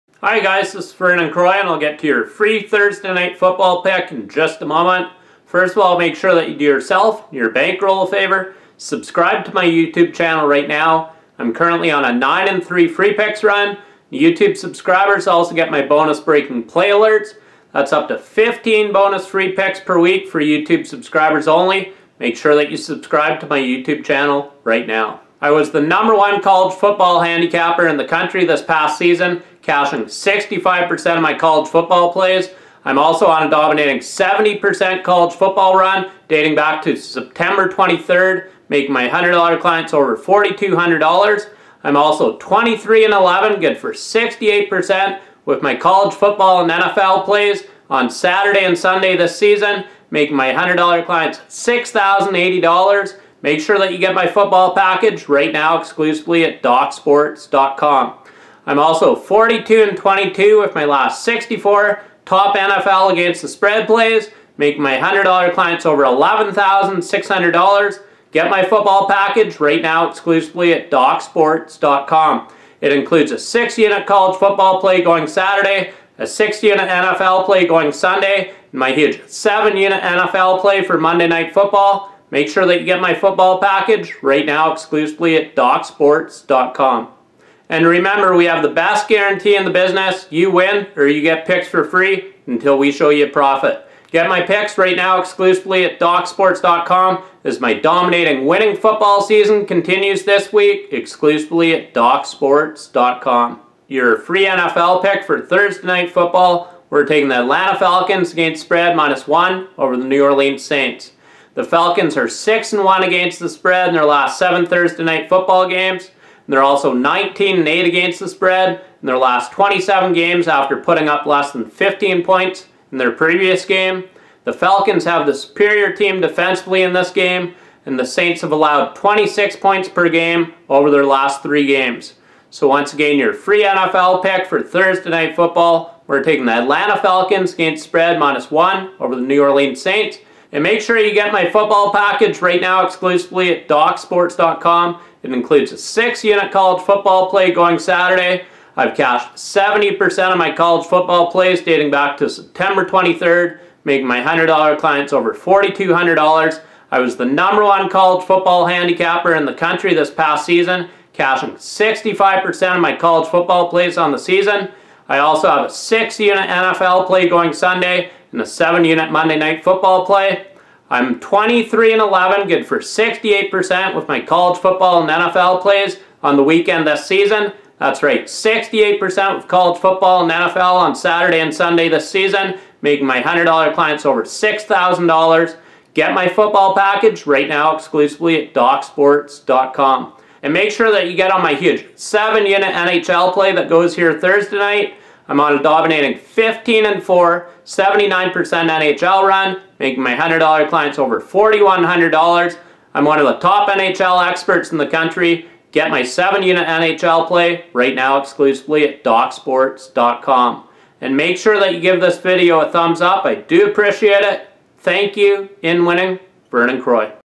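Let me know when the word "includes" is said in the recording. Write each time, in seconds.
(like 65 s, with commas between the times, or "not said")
72 s, 145 s.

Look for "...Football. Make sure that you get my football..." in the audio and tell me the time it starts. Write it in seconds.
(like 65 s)
81 s.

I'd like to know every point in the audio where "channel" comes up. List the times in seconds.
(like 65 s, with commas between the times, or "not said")
10 s, 24 s.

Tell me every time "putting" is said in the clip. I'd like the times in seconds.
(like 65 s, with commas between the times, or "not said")
120 s.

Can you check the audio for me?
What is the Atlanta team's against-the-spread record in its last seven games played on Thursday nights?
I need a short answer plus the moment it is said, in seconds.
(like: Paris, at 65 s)
6 and 1, at 112 s.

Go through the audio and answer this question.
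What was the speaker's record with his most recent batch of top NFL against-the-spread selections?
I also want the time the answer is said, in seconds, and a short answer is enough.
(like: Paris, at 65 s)
42 and 22, at 59 s.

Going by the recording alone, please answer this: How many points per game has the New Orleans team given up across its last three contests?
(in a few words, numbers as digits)
26.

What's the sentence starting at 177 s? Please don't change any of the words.
That's right, 68% of college football and NFL on Saturday and Sunday this season, making my $100 clients over $6,000.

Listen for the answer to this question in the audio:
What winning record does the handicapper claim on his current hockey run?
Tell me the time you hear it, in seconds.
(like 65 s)
196 s.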